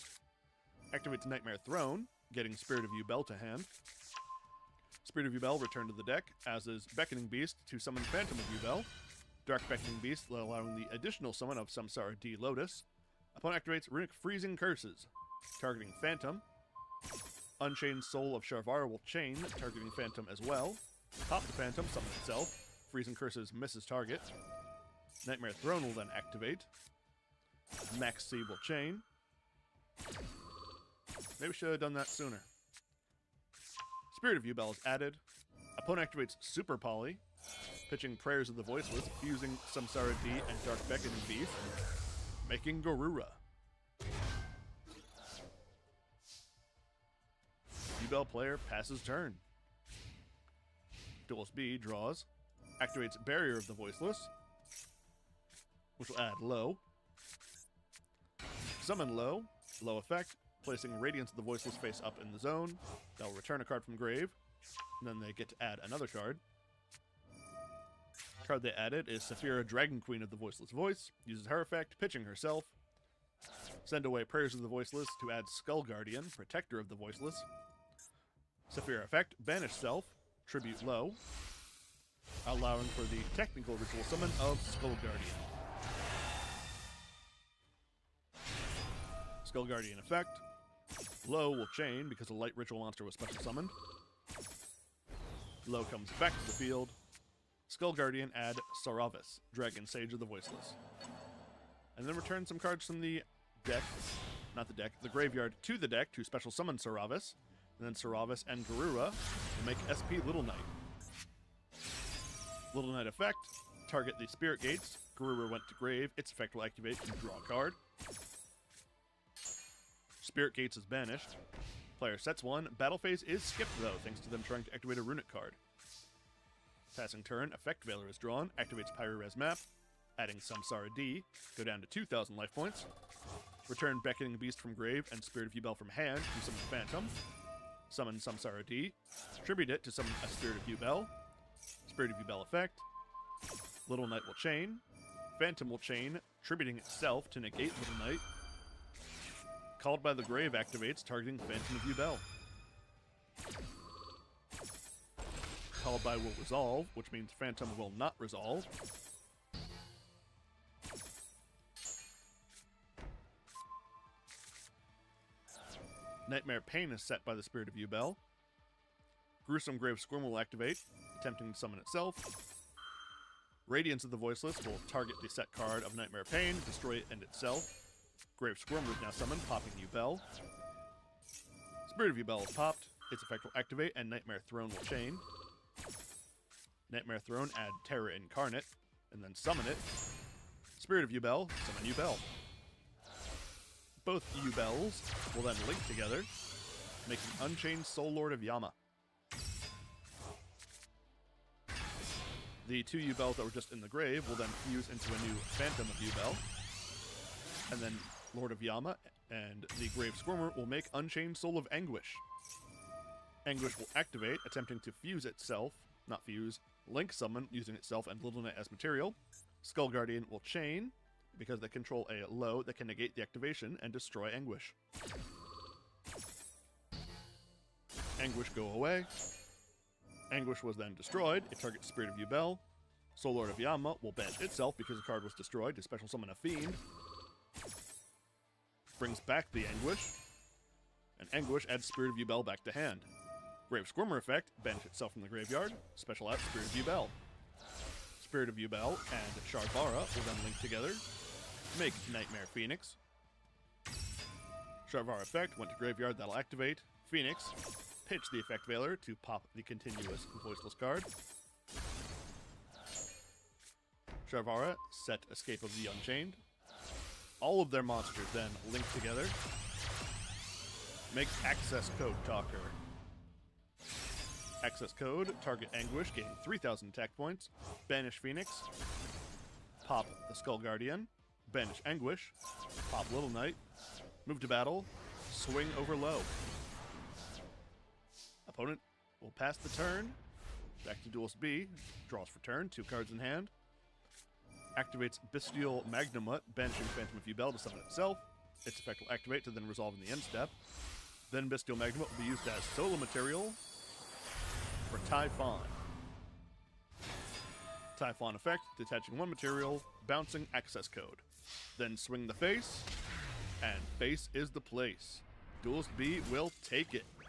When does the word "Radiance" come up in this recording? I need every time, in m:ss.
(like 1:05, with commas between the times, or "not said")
1:00, 2:53.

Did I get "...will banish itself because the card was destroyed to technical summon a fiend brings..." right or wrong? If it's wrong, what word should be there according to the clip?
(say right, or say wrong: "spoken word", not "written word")
wrong: "special", not "technical".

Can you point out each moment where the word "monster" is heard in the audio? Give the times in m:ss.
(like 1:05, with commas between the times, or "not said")
1:32, 4:27.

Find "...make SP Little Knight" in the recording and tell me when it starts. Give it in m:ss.
1:49.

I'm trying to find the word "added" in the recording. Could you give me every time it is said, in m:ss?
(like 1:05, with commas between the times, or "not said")
0:34, 1:08.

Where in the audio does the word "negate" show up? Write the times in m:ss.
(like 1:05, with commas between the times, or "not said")
2:27, 3:42.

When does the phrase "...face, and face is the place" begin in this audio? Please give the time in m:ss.
5:12.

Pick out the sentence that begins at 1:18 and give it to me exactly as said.
Saphira effect, banish self, tribute low, allowing for the technical ritual summon of Skull Guardian.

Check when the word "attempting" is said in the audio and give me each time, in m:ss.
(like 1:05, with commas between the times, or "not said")
2:51, 3:34.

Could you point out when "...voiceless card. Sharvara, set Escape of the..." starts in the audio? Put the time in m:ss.
4:20.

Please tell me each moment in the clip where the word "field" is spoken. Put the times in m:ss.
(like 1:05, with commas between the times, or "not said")
1:36.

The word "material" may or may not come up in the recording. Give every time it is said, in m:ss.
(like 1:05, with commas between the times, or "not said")
3:38, 5:02, 5:09.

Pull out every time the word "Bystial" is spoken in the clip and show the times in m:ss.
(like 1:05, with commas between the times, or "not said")
4:55, 5:01.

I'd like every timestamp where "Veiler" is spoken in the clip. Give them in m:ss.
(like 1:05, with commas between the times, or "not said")
2:07, 4:18.